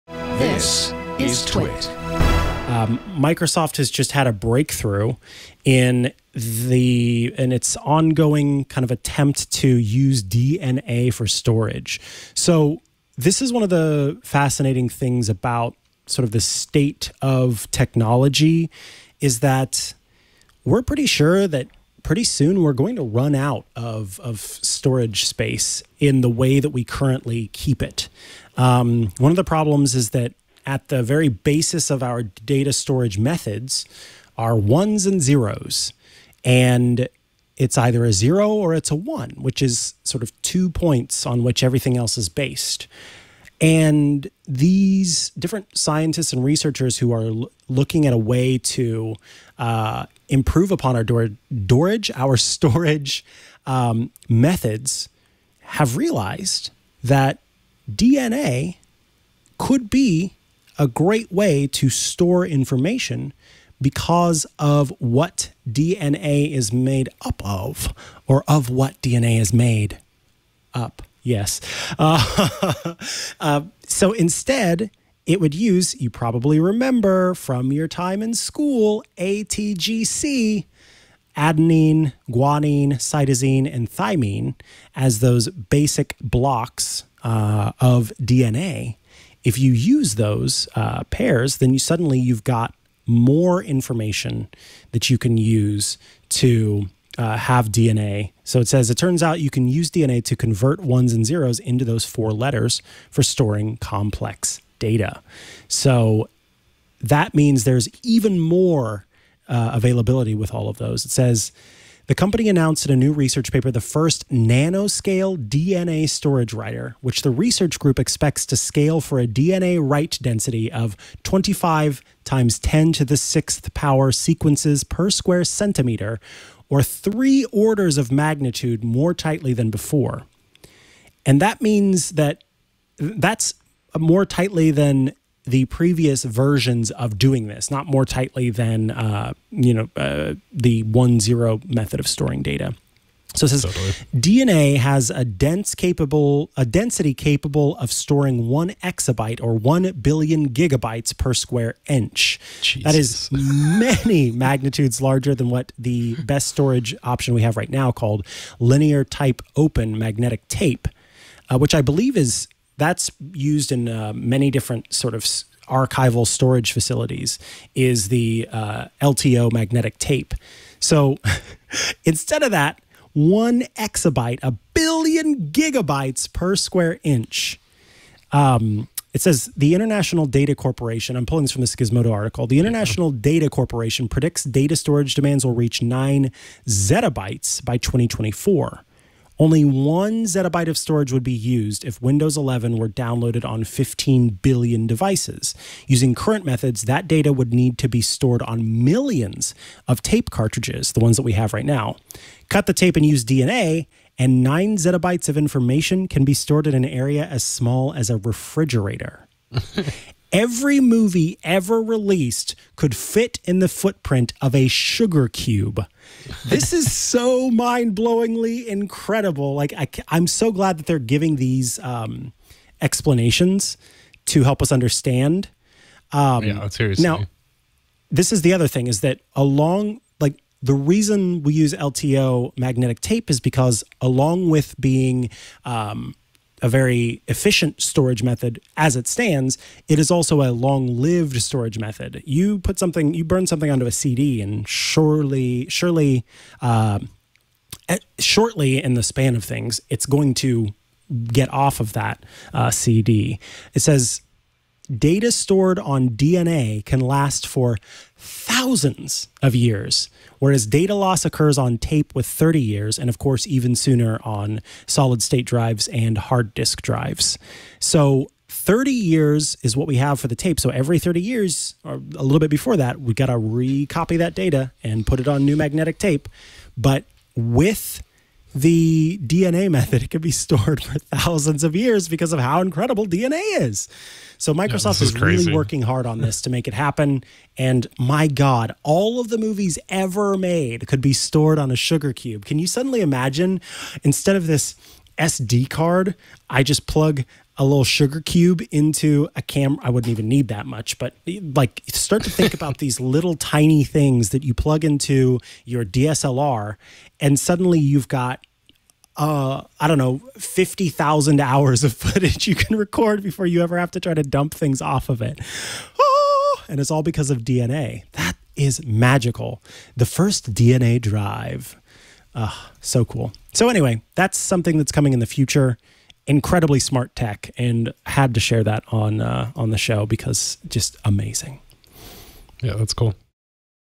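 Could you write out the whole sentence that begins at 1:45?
So that means there's even more uh, availability with all of those.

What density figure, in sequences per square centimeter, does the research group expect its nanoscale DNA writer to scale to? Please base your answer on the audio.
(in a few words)
25 times 10 to the 6th.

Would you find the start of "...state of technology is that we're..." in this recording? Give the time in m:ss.
0:16.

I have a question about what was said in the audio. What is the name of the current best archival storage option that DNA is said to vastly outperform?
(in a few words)
Linear tape open.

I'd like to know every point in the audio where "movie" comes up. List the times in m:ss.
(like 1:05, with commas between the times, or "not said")
3:30, 4:49.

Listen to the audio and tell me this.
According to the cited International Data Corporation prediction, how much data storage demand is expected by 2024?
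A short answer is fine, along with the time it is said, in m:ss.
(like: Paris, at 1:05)
9 zettabytes, at 3:05.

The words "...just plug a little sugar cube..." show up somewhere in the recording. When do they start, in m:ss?
4:56.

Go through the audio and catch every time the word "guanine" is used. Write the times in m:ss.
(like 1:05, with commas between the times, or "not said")
1:22.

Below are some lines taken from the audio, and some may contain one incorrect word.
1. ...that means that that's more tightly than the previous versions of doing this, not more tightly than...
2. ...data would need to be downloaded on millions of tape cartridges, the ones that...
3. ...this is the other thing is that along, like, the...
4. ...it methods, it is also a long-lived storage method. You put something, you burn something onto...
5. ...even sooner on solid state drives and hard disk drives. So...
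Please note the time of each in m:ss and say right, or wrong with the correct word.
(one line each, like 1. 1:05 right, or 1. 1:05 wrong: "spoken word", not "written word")
1. 2:11 right
2. 3:17 wrong: "stored", not "downloaded"
3. 3:48 right
4. 3:58 wrong: "stands", not "methods"
5. 4:23 right.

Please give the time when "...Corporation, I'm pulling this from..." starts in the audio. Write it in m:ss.
3:00.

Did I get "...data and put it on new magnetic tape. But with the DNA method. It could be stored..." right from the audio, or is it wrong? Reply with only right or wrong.
right.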